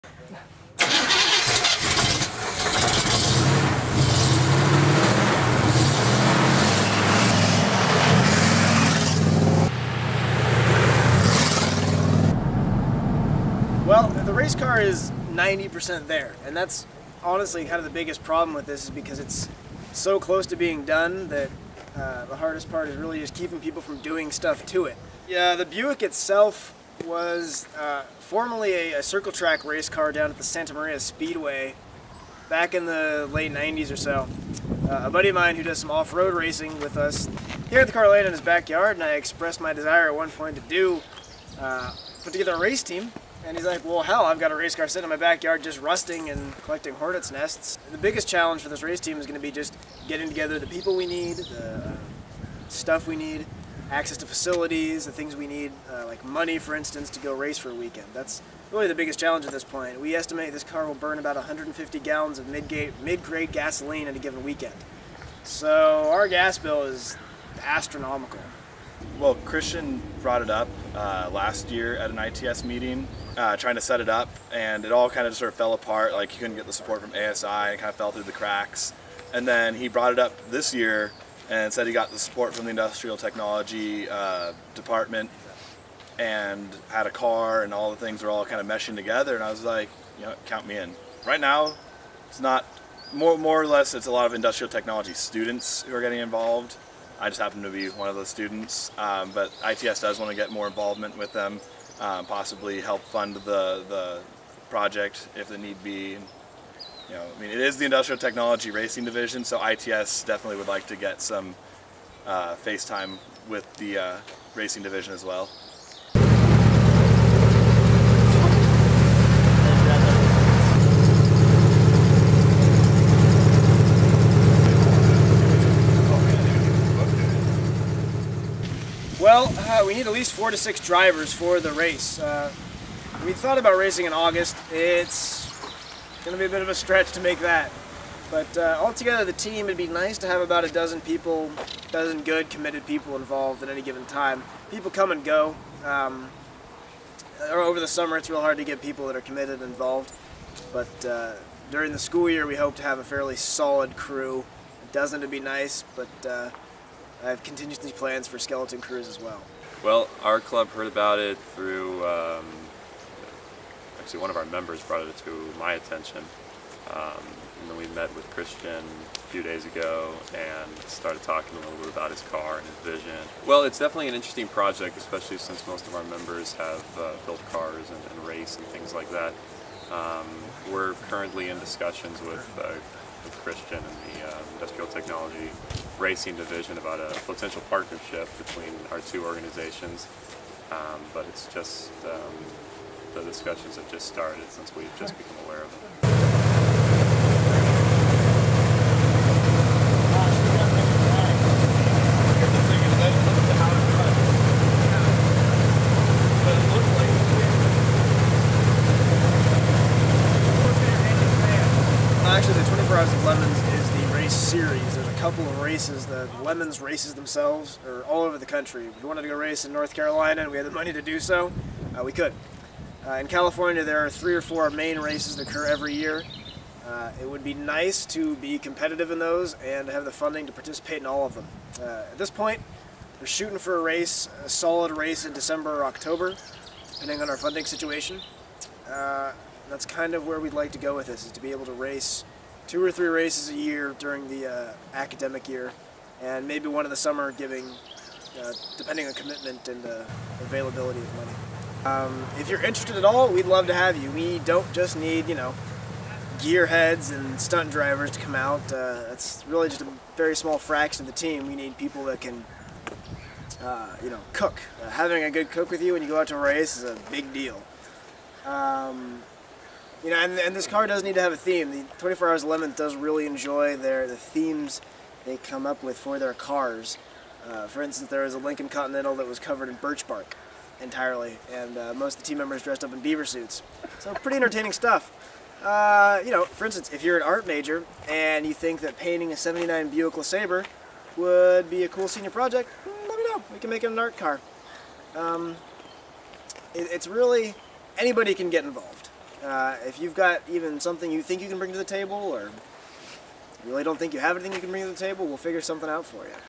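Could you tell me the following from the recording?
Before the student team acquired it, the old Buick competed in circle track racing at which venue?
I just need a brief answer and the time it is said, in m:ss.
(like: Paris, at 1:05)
Santa Maria Speedway, at 0:30.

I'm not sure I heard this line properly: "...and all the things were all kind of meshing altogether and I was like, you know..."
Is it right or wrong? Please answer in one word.
wrong.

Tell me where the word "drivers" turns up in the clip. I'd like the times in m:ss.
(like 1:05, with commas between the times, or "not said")
2:10, 4:17.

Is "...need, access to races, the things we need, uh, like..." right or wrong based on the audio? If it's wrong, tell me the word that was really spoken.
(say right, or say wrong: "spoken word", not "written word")
wrong: "facilities", not "races".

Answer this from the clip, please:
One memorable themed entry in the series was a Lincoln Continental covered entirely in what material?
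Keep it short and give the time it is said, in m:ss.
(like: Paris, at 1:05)
birch bark, at 4:39.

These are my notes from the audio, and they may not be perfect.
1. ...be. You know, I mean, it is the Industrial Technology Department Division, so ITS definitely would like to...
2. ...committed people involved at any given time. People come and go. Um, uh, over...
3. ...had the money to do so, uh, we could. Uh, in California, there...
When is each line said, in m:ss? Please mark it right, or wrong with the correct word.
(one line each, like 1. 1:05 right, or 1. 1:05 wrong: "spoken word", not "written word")
1. 1:45 wrong: "Racing", not "Department"
2. 2:22 right
3. 3:40 right.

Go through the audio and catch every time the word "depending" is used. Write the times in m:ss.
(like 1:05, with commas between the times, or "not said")
3:56, 4:08.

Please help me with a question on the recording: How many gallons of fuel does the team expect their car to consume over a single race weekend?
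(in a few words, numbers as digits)
150.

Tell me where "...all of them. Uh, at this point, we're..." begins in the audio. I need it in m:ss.
3:51.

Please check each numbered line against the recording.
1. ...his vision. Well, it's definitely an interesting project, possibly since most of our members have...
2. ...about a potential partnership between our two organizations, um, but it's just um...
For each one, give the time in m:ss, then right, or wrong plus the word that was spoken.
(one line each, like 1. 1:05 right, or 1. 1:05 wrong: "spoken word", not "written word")
1. 2:52 wrong: "especially", not "possibly"
2. 3:06 right.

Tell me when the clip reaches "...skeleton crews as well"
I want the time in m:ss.
2:38.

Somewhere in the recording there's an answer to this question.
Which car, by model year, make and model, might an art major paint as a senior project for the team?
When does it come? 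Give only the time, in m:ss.
4:49.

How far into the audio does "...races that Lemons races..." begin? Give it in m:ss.
3:35.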